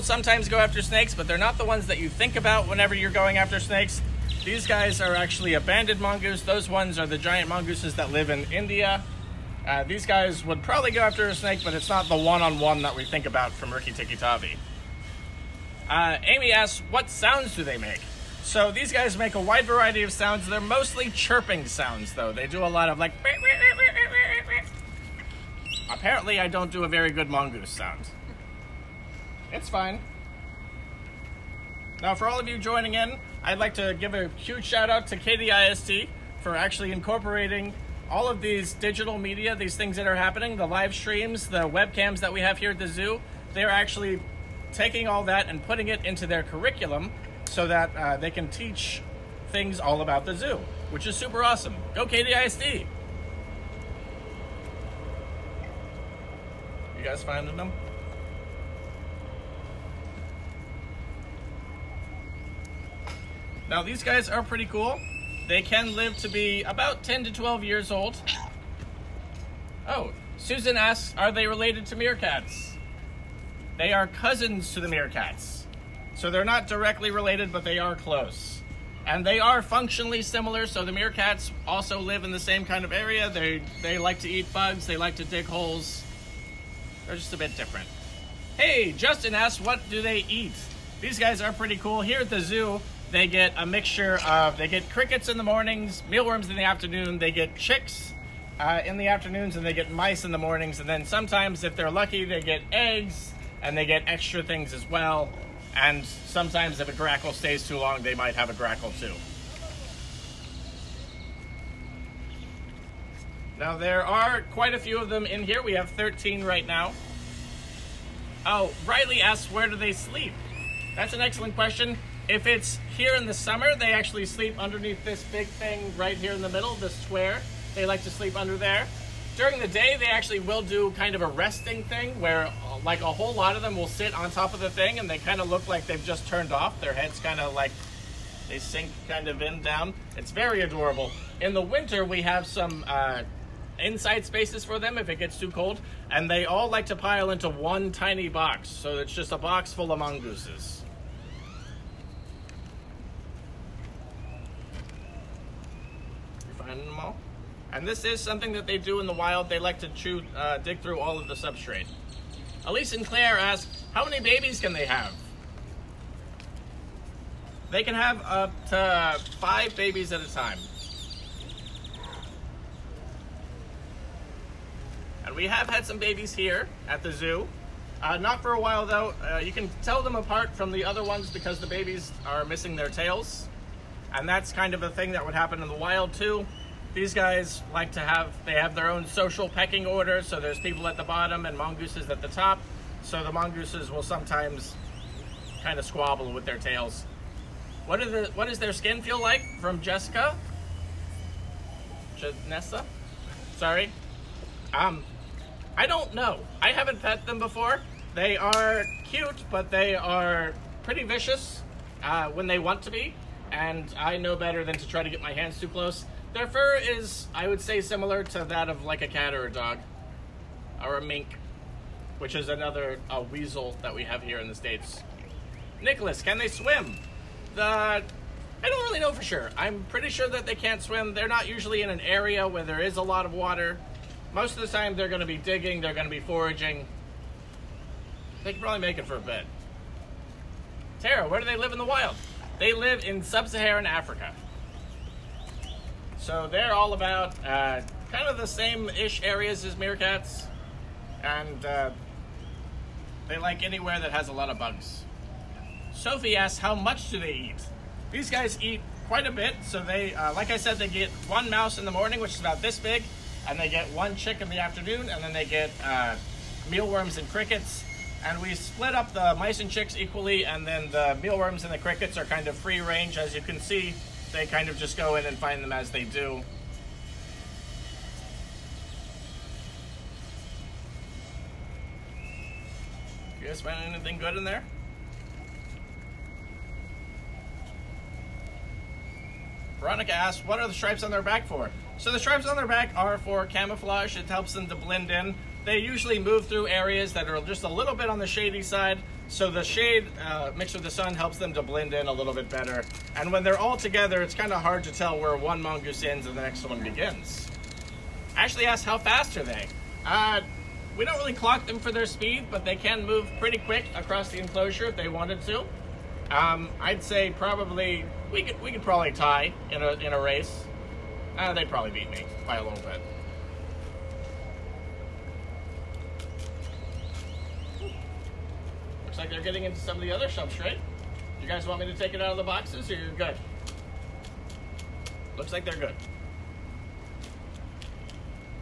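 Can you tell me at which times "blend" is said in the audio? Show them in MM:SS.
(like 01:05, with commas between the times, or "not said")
04:54, 05:01.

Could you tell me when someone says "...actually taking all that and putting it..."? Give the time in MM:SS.
00:43.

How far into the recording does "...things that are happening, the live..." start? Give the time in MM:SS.
00:39.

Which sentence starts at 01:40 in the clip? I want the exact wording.
And then sometimes, if they're lucky, they get eggs, and they get extra things as well.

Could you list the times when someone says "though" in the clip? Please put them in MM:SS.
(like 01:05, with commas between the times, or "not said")
00:22, 02:58.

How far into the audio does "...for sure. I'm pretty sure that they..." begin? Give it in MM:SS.
03:49.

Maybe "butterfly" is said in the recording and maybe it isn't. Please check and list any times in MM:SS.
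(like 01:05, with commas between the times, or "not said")
not said.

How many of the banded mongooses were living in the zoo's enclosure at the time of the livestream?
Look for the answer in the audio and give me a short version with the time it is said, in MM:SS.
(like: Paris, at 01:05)
13, at 01:55.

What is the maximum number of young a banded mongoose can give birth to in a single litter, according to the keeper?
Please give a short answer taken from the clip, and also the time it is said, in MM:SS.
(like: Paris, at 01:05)
5, at 02:49.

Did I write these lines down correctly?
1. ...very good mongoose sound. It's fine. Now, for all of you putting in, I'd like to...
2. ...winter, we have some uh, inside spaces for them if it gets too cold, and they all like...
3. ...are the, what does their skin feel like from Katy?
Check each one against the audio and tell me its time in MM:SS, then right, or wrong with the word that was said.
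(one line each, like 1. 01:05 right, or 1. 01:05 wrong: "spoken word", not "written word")
1. 00:26 wrong: "joining", not "putting"
2. 02:21 right
3. 03:18 wrong: "Jessica", not "Katy".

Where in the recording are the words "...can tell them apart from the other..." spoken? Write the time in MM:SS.
02:59.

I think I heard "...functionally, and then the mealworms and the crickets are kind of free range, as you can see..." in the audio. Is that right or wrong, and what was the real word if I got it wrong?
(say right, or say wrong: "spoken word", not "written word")
wrong: "equally", not "functionally".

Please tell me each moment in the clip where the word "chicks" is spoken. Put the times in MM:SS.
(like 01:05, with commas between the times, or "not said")
01:37, 04:24, 04:29.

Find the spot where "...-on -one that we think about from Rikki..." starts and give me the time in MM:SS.
00:12.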